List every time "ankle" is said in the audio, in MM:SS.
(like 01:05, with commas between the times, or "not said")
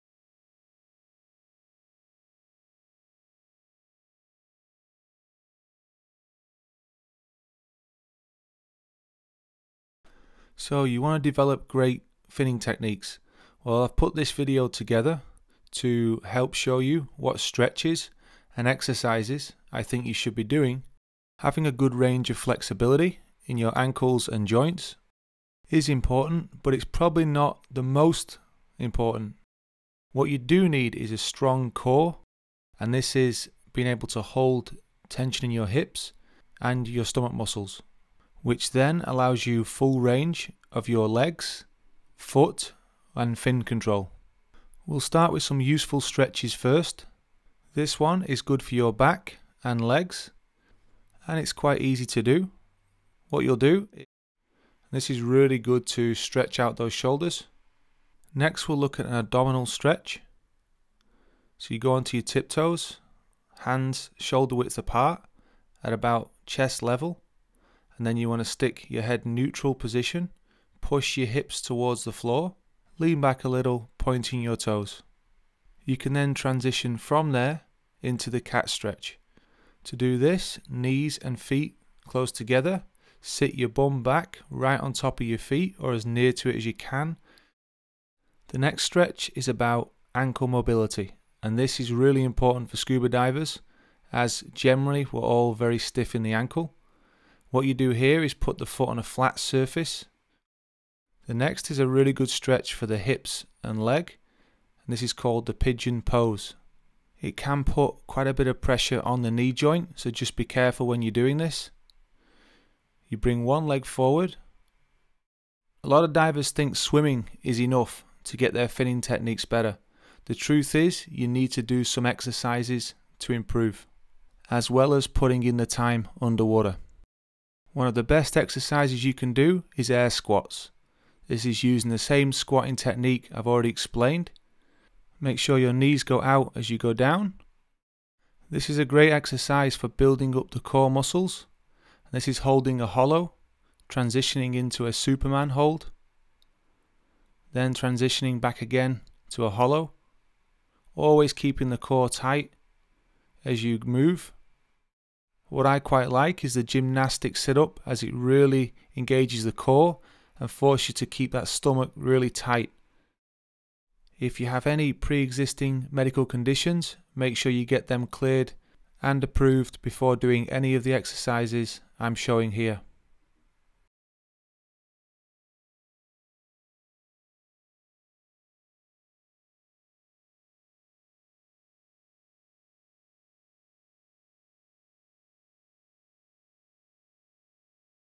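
00:23, 01:30, 01:36.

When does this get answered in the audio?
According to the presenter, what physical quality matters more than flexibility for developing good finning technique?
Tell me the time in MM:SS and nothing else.
00:31.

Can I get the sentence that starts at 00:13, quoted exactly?
Well, I've put this video together to help show you what stretches and exercises I think you should be doing.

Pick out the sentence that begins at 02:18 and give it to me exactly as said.
This is a great exercise for building up the core muscles.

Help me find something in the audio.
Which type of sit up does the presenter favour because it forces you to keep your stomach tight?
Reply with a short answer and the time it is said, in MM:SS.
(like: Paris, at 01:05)
Gymnastic sit up, at 02:36.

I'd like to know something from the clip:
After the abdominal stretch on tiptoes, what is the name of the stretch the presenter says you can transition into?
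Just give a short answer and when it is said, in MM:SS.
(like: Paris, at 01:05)
Cat stretch, at 01:18.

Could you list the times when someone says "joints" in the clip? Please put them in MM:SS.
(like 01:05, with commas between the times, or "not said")
00:24, 01:49.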